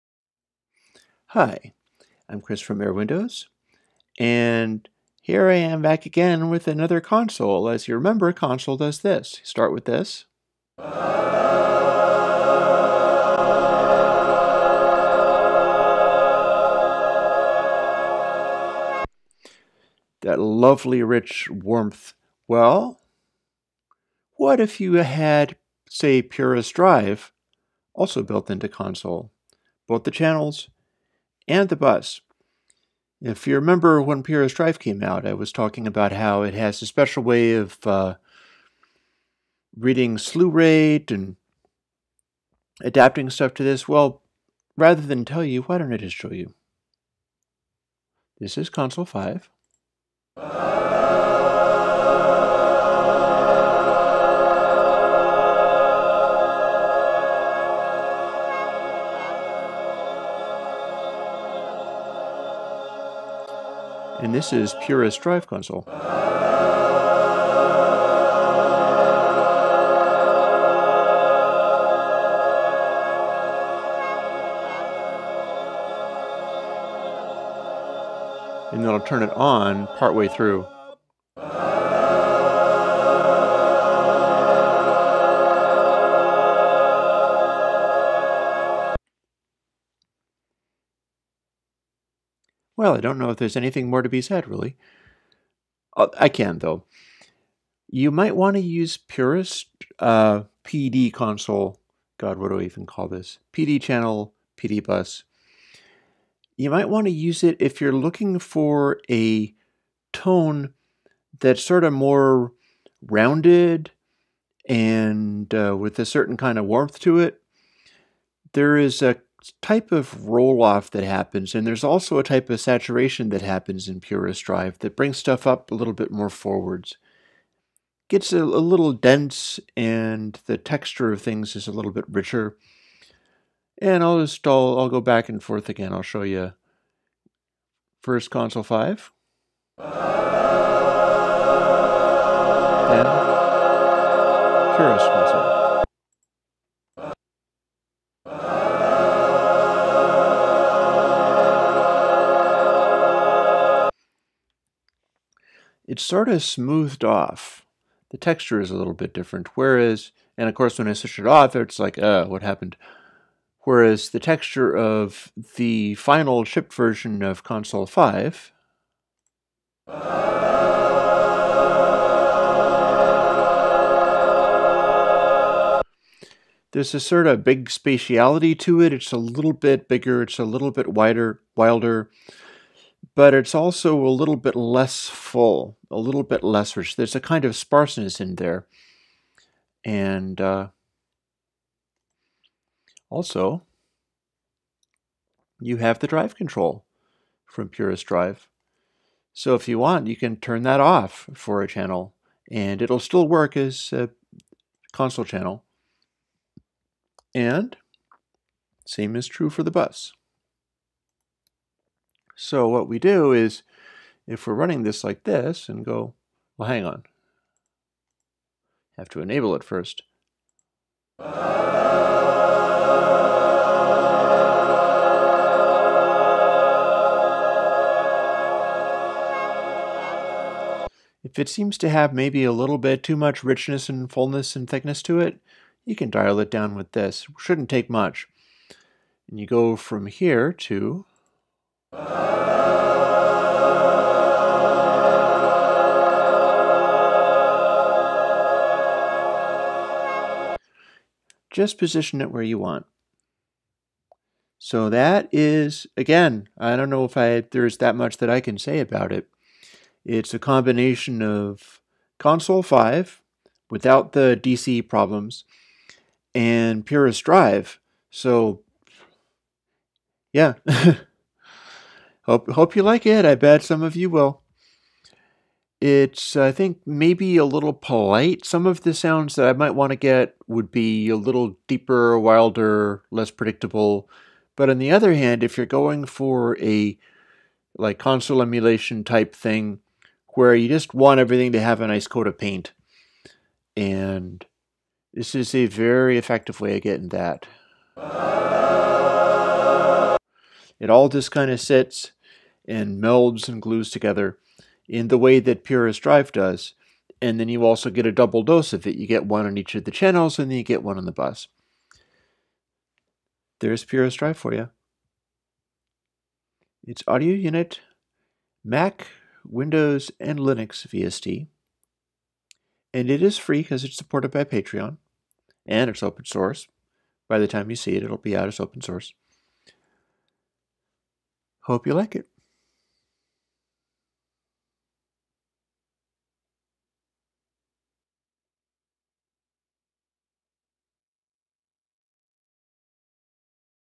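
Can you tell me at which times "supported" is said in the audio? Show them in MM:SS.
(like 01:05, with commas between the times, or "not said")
05:23.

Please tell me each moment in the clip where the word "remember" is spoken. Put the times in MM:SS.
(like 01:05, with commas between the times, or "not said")
00:07, 00:33.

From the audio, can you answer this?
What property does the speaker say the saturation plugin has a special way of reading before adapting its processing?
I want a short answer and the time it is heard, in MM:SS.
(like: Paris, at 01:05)
Slew rate, at 00:40.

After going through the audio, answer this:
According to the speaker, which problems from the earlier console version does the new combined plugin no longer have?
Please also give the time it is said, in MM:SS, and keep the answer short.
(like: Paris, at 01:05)
DC problems, at 04:24.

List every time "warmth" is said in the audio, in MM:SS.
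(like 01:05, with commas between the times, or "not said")
00:21, 01:56.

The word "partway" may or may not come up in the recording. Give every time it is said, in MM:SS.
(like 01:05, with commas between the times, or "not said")
01:19.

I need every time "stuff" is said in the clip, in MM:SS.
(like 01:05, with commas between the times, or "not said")
00:43, 02:05.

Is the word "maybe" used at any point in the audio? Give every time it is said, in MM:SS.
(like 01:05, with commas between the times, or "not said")
03:52, 04:36.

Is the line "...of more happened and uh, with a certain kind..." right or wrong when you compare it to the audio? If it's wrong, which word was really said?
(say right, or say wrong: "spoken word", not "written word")
wrong: "rounded", not "happened".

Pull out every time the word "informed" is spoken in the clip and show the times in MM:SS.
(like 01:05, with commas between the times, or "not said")
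not said.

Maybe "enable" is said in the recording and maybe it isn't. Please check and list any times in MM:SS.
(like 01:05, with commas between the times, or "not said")
03:39.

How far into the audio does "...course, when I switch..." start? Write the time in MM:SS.
02:40.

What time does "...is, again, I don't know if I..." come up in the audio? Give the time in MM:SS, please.
04:15.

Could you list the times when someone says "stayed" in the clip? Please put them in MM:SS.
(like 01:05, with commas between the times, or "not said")
not said.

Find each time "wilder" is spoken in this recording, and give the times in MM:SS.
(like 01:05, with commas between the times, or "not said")
03:01, 04:42.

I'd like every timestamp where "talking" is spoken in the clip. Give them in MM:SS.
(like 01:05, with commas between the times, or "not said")
00:35.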